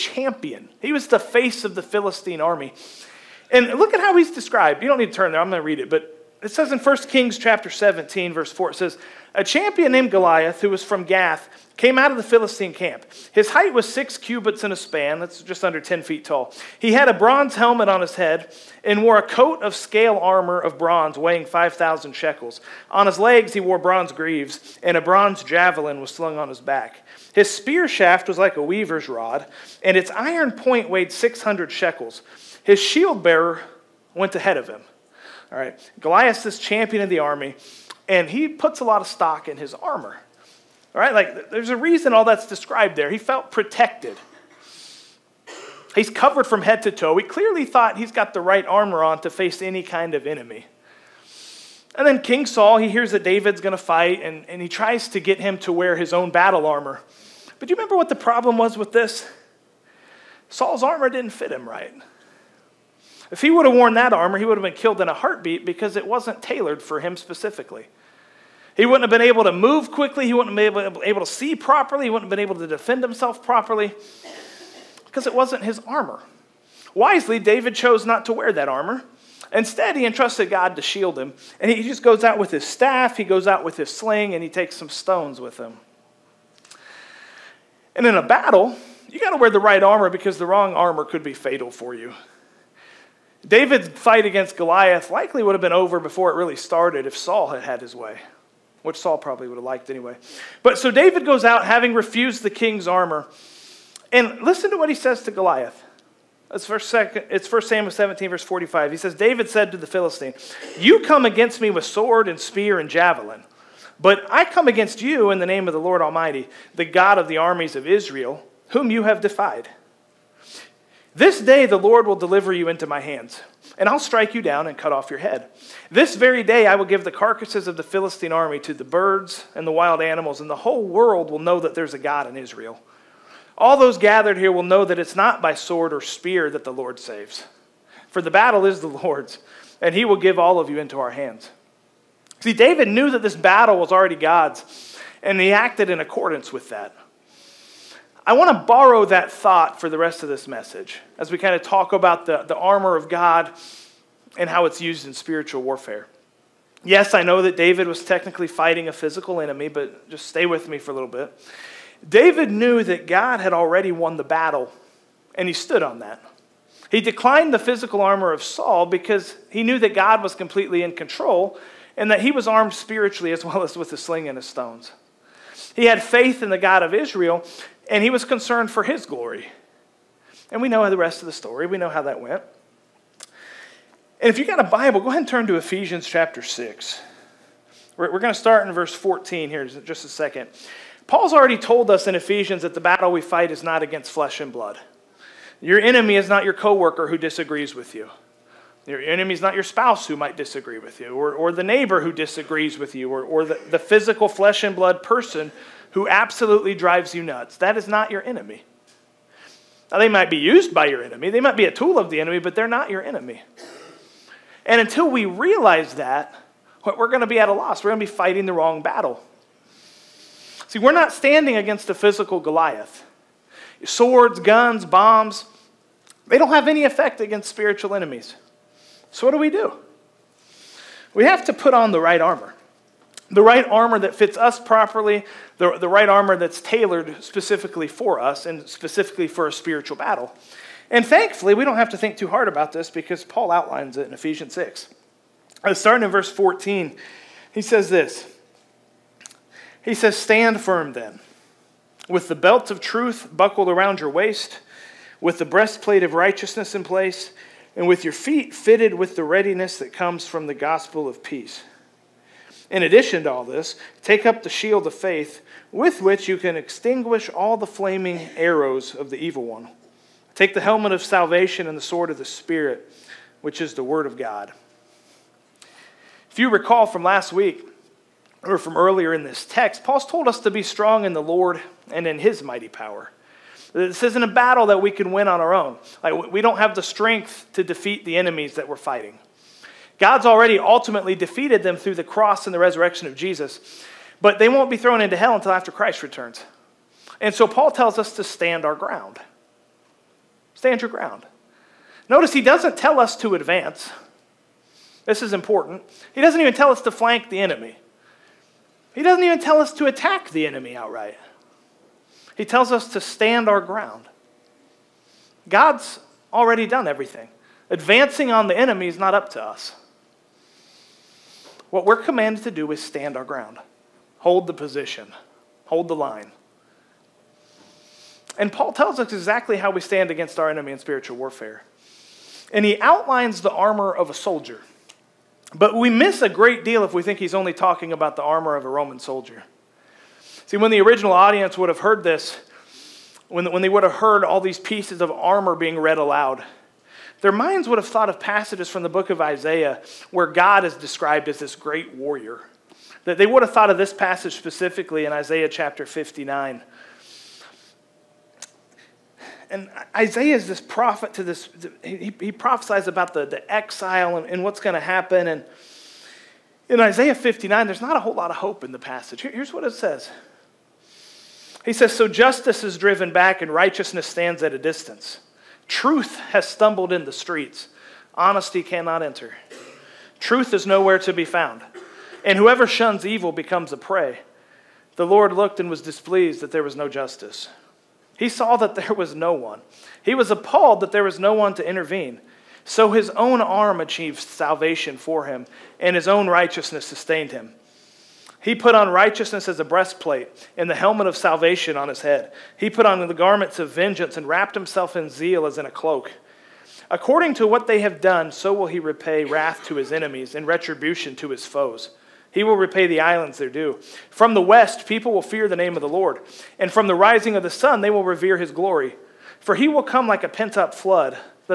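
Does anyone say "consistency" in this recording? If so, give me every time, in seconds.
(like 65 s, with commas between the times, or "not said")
not said.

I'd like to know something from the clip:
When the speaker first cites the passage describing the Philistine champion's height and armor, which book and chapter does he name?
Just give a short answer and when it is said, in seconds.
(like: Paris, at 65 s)
1 Kings 17, at 6 s.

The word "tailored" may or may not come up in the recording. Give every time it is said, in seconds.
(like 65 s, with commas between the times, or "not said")
66 s, 236 s.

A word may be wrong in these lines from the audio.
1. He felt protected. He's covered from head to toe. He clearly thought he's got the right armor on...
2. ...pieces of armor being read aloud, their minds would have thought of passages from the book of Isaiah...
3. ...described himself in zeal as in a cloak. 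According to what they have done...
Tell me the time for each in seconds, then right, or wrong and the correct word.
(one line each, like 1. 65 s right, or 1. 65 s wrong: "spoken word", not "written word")
1. 43 s right
2. 344 s right
3. 404 s wrong: "wrapped", not "described".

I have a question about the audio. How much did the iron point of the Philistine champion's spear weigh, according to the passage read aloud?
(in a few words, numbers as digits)
600 shekels.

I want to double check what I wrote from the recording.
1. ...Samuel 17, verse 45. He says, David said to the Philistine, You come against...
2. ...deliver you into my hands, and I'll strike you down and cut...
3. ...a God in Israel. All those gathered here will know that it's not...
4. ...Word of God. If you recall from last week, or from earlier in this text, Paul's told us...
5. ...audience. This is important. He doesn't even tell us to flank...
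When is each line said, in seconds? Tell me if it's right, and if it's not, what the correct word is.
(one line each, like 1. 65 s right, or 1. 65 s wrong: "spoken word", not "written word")
1. 107 s right
2. 122 s right
3. 131 s right
4. 273 s right
5. 303 s wrong: "advance", not "audience".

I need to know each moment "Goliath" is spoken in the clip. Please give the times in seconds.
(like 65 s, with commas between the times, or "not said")
10 s, 36 s, 94 s, 105 s, 222 s.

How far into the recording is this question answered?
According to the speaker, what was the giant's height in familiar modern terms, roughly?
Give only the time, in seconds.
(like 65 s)
15 s.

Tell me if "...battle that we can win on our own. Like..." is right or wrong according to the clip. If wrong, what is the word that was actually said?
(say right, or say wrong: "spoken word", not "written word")
right.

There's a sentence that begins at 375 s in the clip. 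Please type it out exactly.
Truth has stumbled in the streets.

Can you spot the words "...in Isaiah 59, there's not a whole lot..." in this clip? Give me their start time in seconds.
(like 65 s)
366 s.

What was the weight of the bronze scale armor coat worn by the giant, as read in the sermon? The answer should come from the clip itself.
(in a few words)
5,000 shekels.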